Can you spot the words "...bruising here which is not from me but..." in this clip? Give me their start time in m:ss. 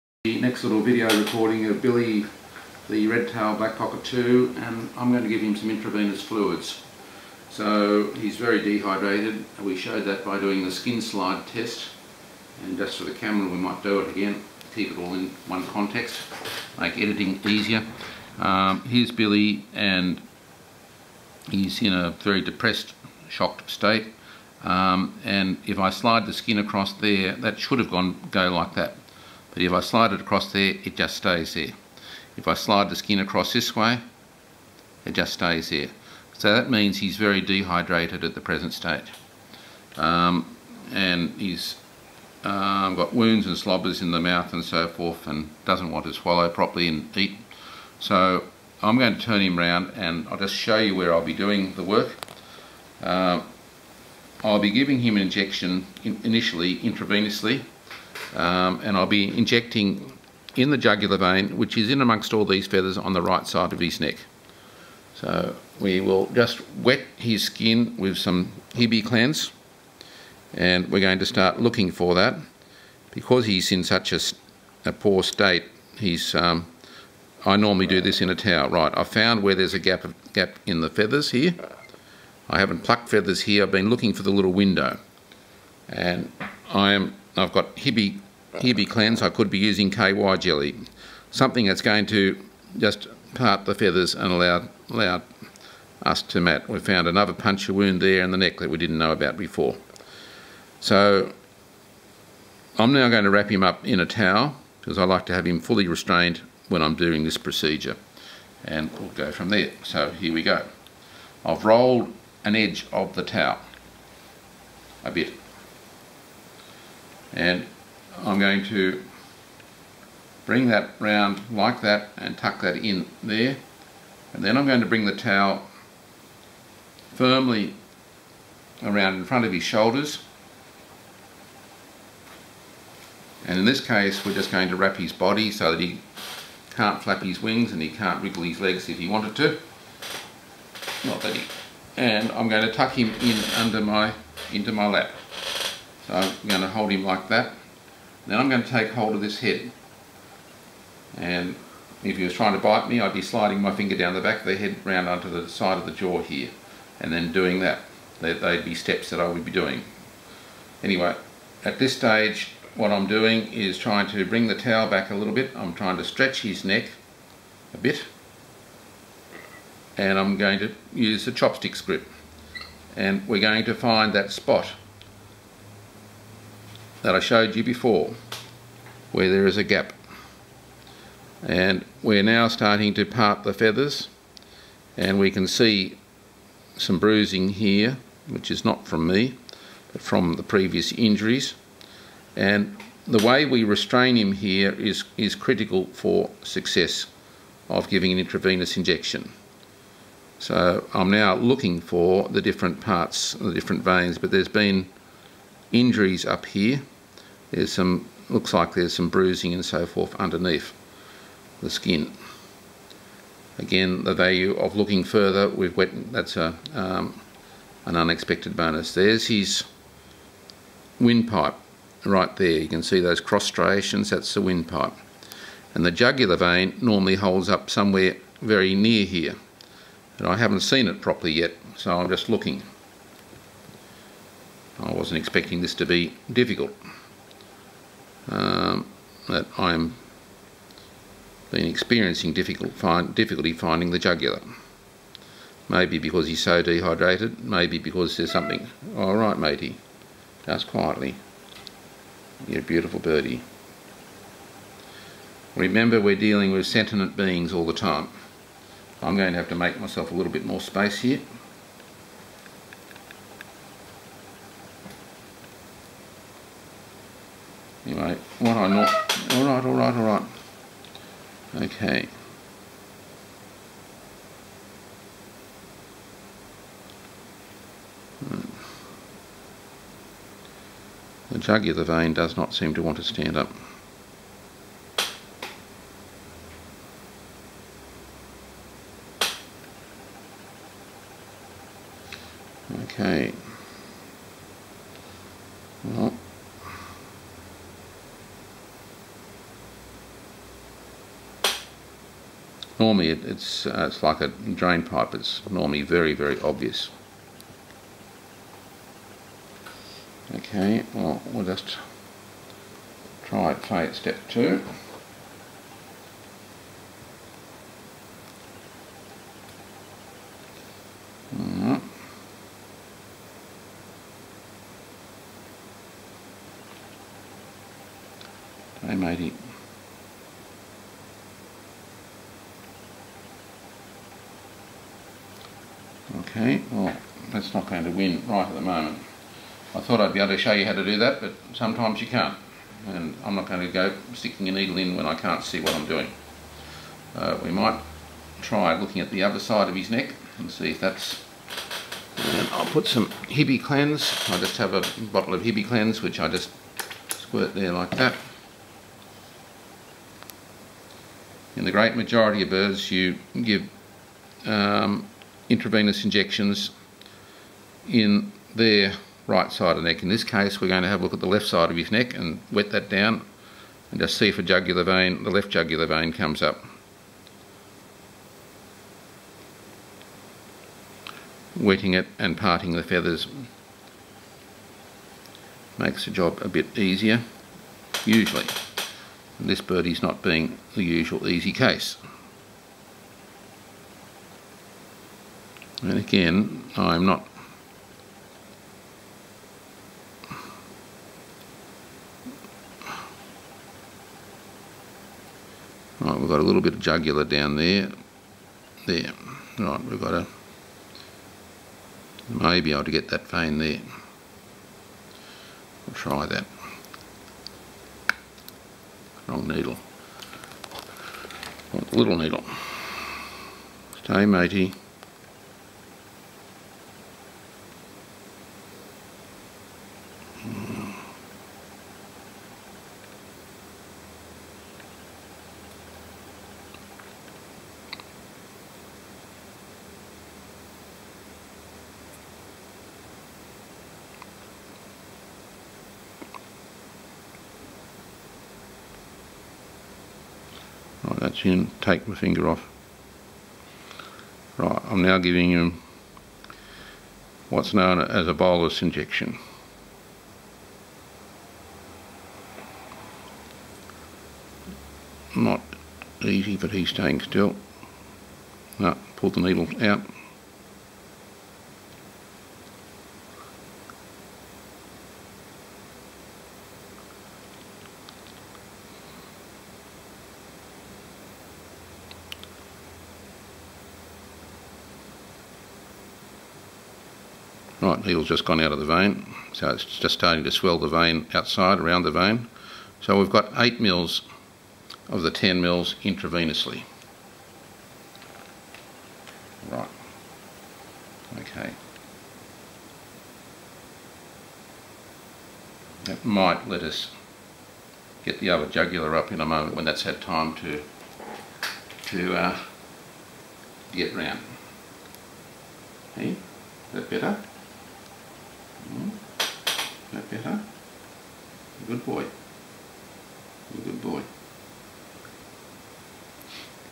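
3:06.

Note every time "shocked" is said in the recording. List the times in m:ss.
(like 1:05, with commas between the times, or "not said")
0:23.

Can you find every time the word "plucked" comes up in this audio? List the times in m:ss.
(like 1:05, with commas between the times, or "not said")
1:22.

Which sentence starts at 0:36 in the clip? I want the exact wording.
So that means he's very dehydrated at the present state.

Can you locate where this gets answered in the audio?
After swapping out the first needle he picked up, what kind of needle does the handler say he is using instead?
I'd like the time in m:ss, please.
7:01.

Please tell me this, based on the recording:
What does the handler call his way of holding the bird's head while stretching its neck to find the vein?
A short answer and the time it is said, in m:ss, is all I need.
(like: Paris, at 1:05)
chopstick grip, at 2:51.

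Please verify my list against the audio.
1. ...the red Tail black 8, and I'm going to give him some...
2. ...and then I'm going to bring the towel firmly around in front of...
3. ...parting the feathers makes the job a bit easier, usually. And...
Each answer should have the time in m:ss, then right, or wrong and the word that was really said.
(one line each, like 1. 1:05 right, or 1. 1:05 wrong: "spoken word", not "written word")
1. 0:02 wrong: "2", not "8"
2. 2:04 right
3. 6:22 right.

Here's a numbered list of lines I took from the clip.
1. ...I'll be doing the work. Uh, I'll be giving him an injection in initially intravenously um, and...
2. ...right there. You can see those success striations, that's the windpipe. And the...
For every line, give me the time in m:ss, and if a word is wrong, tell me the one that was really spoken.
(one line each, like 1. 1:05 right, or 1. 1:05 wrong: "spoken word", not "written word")
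1. 0:51 right
2. 3:42 wrong: "cross", not "success".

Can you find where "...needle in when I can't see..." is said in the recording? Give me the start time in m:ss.
5:44.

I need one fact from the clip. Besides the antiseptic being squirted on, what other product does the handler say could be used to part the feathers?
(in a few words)
KY Jelly.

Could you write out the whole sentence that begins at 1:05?
So we will just wet his skin with some Hibiclens, and we're going to start looking for that.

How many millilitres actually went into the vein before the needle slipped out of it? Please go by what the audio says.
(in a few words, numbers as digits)
8 mils.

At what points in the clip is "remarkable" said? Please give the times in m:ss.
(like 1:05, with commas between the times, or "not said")
not said.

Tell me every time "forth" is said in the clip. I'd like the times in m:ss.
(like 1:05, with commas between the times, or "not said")
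0:44, 3:29.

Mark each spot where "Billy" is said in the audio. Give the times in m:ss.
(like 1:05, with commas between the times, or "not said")
0:01, 0:19.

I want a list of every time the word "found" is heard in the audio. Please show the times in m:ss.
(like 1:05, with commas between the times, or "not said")
1:19, 1:36.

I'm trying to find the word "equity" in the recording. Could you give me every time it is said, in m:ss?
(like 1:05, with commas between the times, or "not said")
not said.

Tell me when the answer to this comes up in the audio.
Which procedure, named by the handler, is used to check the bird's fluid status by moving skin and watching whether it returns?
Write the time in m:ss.
0:10.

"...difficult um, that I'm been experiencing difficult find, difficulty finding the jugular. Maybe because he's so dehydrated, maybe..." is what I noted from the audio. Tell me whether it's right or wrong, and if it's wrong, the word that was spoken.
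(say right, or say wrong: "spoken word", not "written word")
right.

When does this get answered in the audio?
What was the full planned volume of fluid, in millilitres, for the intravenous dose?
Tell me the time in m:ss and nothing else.
8:15.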